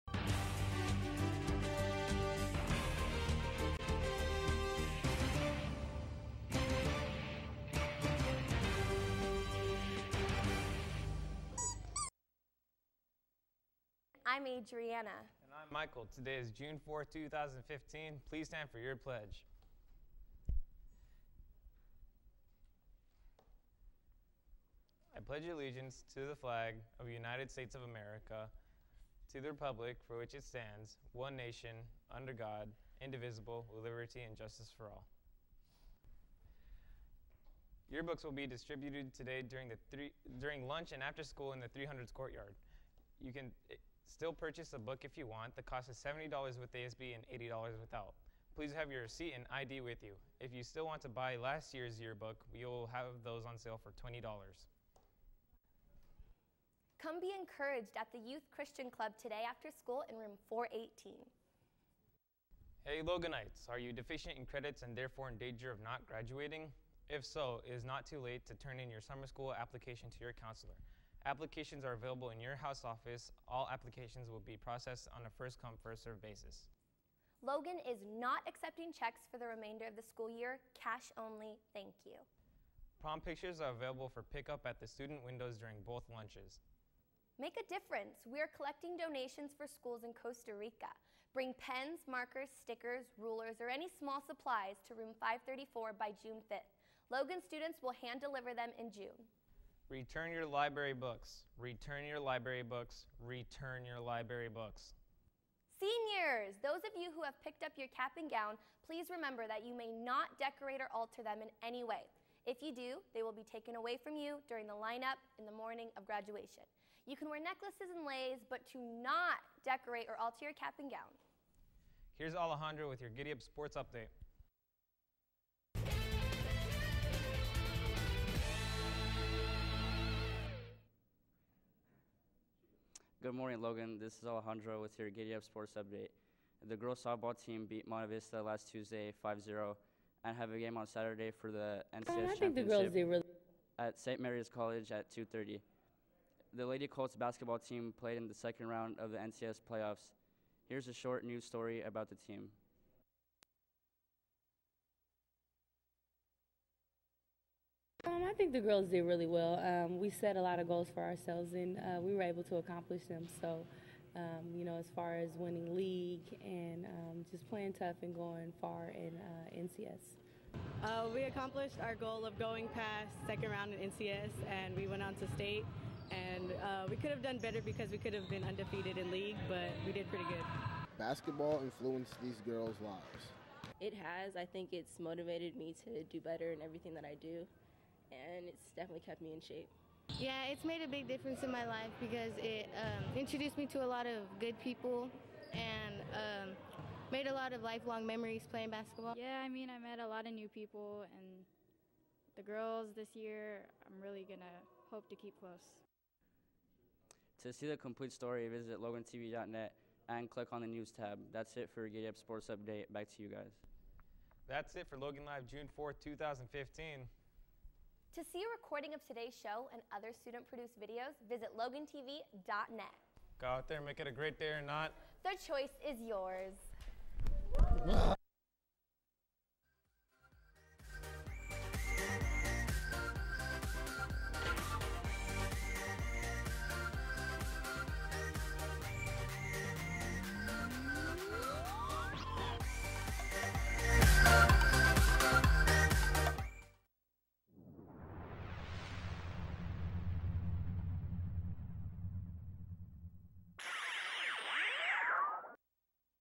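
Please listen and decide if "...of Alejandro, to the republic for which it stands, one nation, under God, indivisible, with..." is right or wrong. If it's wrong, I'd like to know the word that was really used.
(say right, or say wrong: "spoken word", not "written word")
wrong: "America", not "Alejandro".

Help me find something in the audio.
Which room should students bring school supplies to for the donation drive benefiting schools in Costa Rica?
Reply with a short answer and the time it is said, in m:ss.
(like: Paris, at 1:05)
Room 534, at 1:34.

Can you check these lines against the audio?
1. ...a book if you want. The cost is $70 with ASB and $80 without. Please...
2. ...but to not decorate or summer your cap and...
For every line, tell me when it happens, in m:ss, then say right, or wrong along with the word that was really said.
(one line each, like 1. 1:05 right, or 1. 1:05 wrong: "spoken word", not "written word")
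1. 0:44 right
2. 1:58 wrong: "alter", not "summer".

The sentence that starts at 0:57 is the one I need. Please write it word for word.
Come be encouraged at the Youth Christian Club today after school in room 418.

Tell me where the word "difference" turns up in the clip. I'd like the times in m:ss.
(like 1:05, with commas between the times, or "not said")
1:27, 3:11.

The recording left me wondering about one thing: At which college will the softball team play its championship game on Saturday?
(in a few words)
St. Mary's College.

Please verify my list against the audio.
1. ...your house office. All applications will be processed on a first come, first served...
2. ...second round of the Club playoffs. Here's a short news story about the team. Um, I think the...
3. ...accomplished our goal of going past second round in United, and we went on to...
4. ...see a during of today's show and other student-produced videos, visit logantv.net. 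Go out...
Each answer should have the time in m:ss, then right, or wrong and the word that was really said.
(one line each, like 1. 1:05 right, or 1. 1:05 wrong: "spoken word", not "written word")
1. 1:12 right
2. 2:28 wrong: "NCS", not "Club"
3. 2:51 wrong: "NCS", not "United"
4. 3:38 wrong: "recording", not "during".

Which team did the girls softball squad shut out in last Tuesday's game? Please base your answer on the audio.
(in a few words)
Monta Vista.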